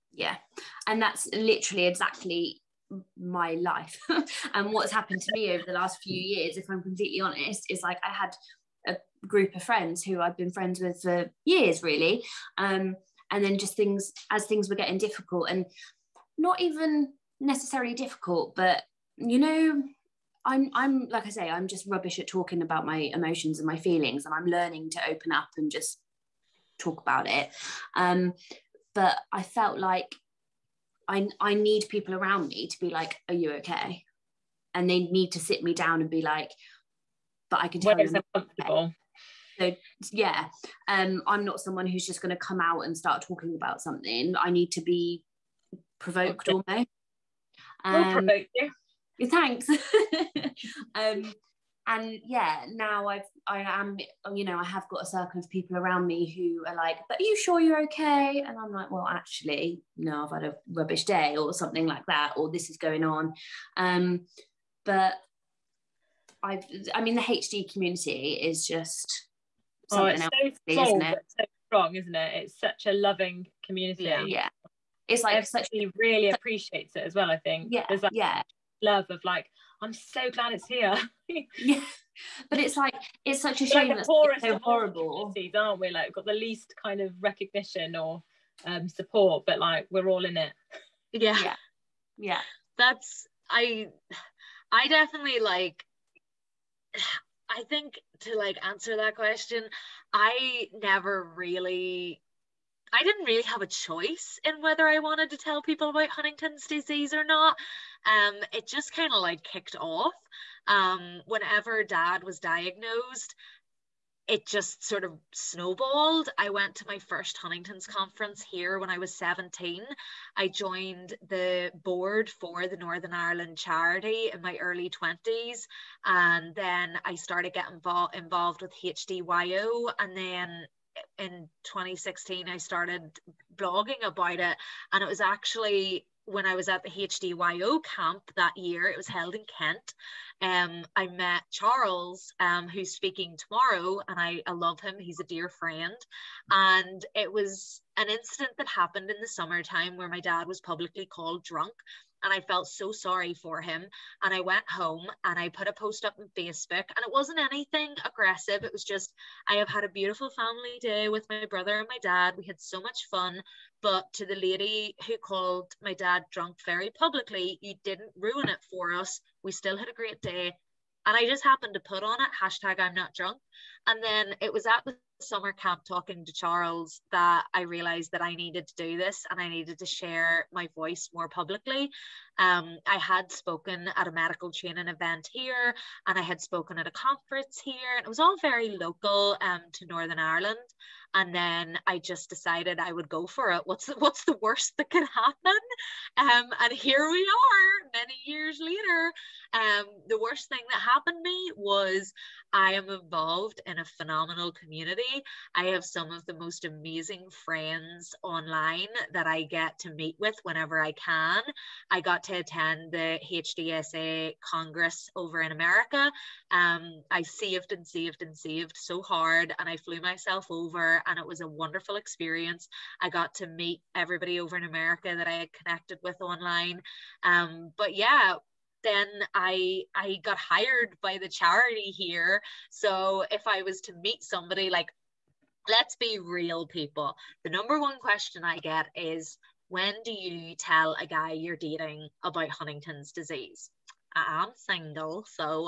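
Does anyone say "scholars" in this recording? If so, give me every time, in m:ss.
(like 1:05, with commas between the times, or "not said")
not said.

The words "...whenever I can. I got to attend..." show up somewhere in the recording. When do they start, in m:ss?
3:30.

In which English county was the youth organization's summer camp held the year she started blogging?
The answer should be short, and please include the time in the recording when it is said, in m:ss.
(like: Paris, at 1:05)
Kent, at 2:19.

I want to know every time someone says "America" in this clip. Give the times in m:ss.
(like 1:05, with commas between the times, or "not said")
3:35, 3:44.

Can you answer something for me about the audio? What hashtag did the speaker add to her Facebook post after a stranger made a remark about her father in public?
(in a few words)
#I'm not drunk.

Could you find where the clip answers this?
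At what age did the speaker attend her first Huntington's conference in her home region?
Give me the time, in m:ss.
1:59.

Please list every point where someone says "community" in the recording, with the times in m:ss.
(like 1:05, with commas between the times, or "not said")
1:07, 1:13, 3:24.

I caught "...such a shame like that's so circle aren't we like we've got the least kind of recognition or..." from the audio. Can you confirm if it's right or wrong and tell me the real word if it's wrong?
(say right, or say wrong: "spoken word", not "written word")
wrong: "horrible", not "circle".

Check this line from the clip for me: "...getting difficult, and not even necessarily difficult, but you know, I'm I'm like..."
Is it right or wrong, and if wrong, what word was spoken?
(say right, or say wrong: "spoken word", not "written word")
right.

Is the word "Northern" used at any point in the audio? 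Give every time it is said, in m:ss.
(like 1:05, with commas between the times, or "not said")
2:02, 3:09.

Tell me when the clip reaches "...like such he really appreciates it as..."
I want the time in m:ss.
1:15.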